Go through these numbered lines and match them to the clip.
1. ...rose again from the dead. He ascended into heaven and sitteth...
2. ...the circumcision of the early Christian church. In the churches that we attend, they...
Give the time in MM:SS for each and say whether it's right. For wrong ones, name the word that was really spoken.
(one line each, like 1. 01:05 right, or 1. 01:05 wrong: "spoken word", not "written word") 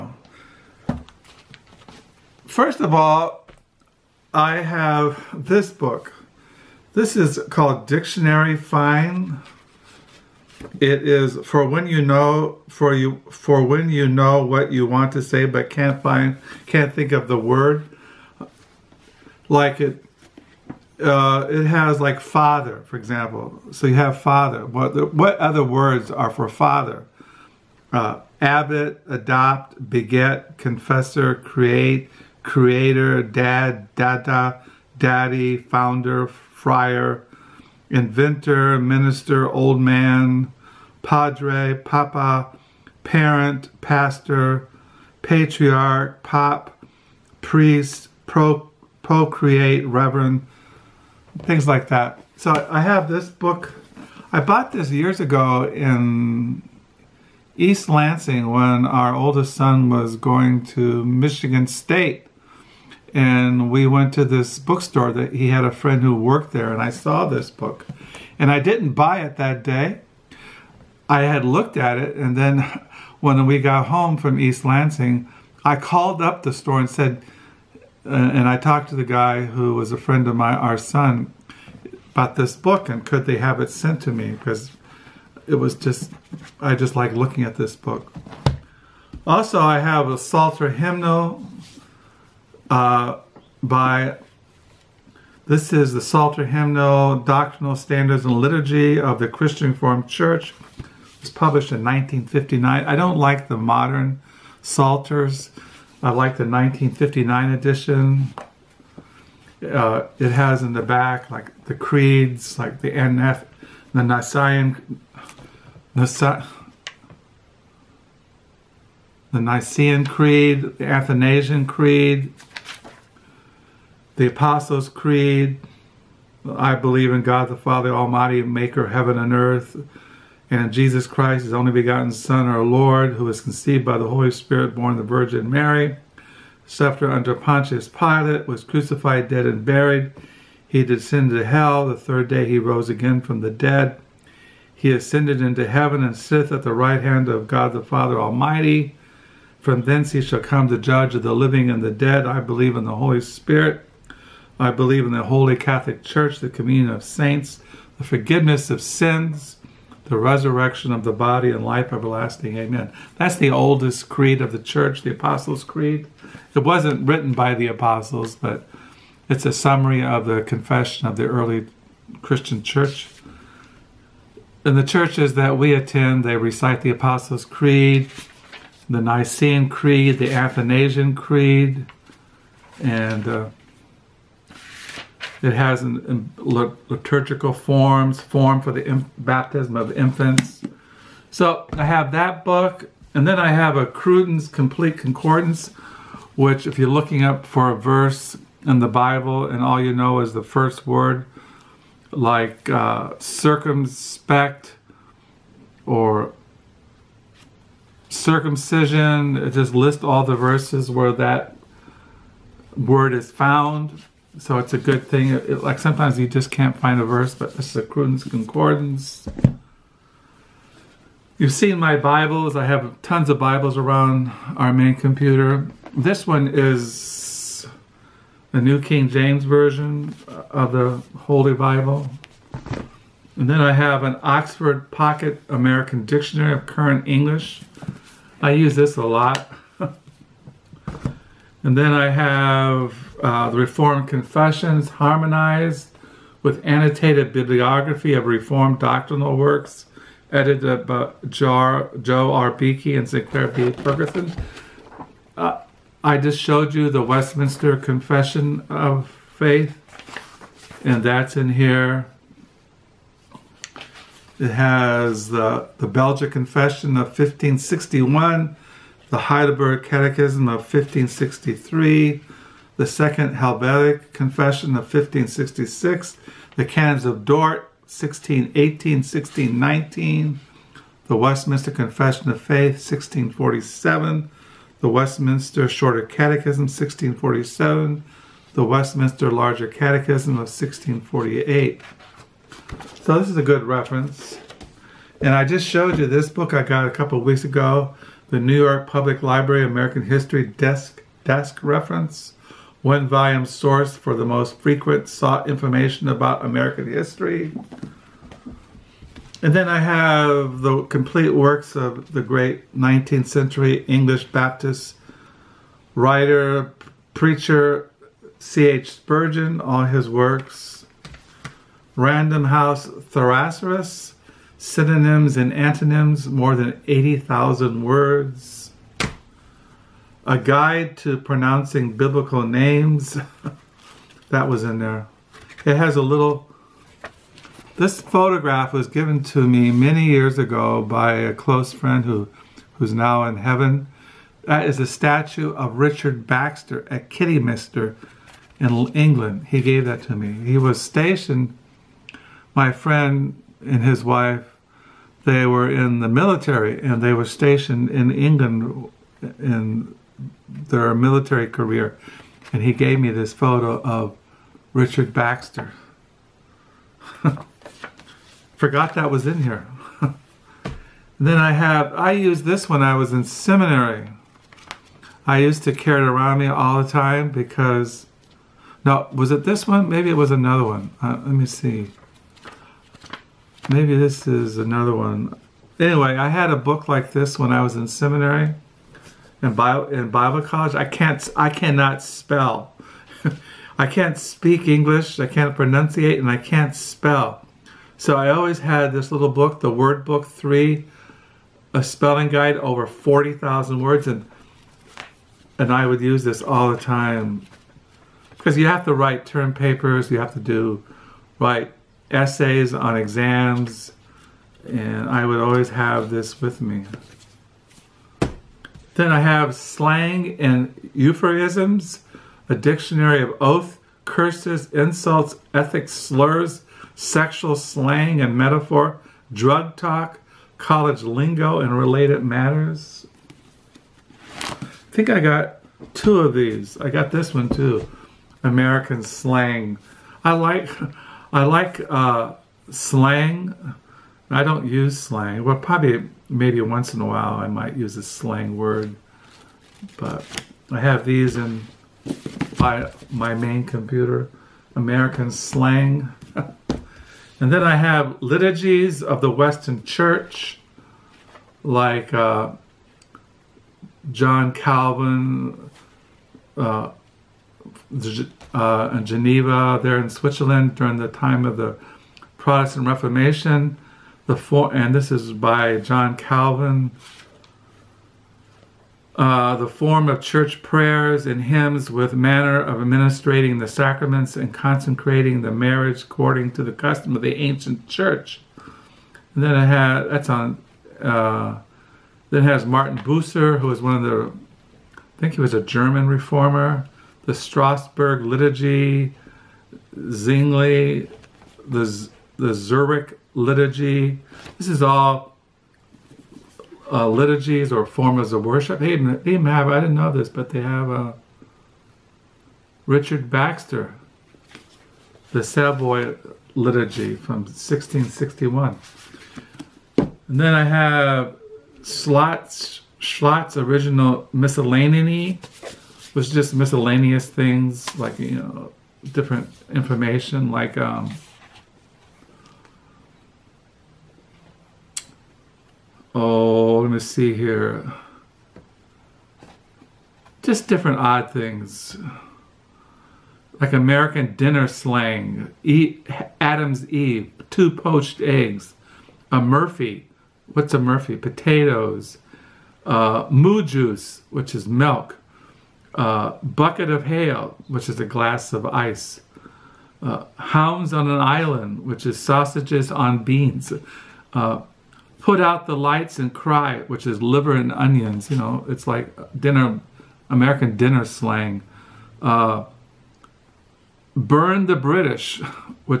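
1. 02:22 right
2. 02:50 wrong: "confession", not "circumcision".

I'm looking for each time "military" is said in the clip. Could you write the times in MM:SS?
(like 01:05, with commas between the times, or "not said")
05:56, 06:00.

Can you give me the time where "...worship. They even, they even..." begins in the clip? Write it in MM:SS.
08:28.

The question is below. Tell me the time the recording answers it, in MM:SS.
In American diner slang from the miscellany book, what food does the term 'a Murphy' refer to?
09:11.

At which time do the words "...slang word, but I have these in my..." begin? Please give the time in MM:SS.
07:28.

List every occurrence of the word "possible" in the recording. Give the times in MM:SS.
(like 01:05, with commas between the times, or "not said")
not said.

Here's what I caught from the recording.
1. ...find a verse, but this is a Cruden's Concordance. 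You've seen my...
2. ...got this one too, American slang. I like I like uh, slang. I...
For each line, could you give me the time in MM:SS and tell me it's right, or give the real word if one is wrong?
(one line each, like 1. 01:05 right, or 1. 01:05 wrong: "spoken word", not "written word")
1. 03:36 right
2. 07:16 right.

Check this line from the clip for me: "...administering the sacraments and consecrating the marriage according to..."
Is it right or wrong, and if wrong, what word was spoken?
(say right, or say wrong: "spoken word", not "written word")
right.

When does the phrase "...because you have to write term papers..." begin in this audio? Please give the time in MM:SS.
06:48.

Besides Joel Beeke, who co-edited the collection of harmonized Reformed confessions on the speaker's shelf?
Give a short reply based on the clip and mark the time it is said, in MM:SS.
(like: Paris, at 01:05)
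Sinclair B. Ferguson, at 04:13.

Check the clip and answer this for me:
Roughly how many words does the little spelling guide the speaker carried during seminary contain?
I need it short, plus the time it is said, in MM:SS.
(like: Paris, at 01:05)
40,000, at 06:42.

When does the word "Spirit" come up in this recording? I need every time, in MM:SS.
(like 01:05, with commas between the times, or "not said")
02:14, 02:33.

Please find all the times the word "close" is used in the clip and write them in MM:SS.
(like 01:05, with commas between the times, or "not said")
05:41.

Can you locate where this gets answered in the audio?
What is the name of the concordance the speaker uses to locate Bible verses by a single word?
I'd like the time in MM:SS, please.
03:13.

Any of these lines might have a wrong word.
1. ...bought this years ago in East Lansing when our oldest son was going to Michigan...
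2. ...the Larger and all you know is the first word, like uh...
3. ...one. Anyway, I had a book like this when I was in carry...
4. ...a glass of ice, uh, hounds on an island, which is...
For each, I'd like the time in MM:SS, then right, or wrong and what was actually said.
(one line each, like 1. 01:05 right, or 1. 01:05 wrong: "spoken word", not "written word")
1. 00:54 right
2. 03:18 wrong: "Bible", not "Larger"
3. 06:24 wrong: "seminary", not "carry"
4. 09:17 right.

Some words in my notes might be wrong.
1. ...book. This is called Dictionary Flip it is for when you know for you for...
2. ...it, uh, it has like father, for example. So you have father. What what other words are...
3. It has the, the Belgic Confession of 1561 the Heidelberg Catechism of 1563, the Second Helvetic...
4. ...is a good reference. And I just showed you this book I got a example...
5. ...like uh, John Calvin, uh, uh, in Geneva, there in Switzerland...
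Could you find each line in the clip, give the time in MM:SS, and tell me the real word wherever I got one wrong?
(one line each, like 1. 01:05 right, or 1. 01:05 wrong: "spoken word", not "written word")
1. 00:05 right
2. 00:19 right
3. 04:24 right
4. 04:53 wrong: "couple", not "example"
5. 07:41 right.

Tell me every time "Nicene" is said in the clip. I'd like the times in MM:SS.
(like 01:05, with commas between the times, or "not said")
01:54, 01:59, 02:58.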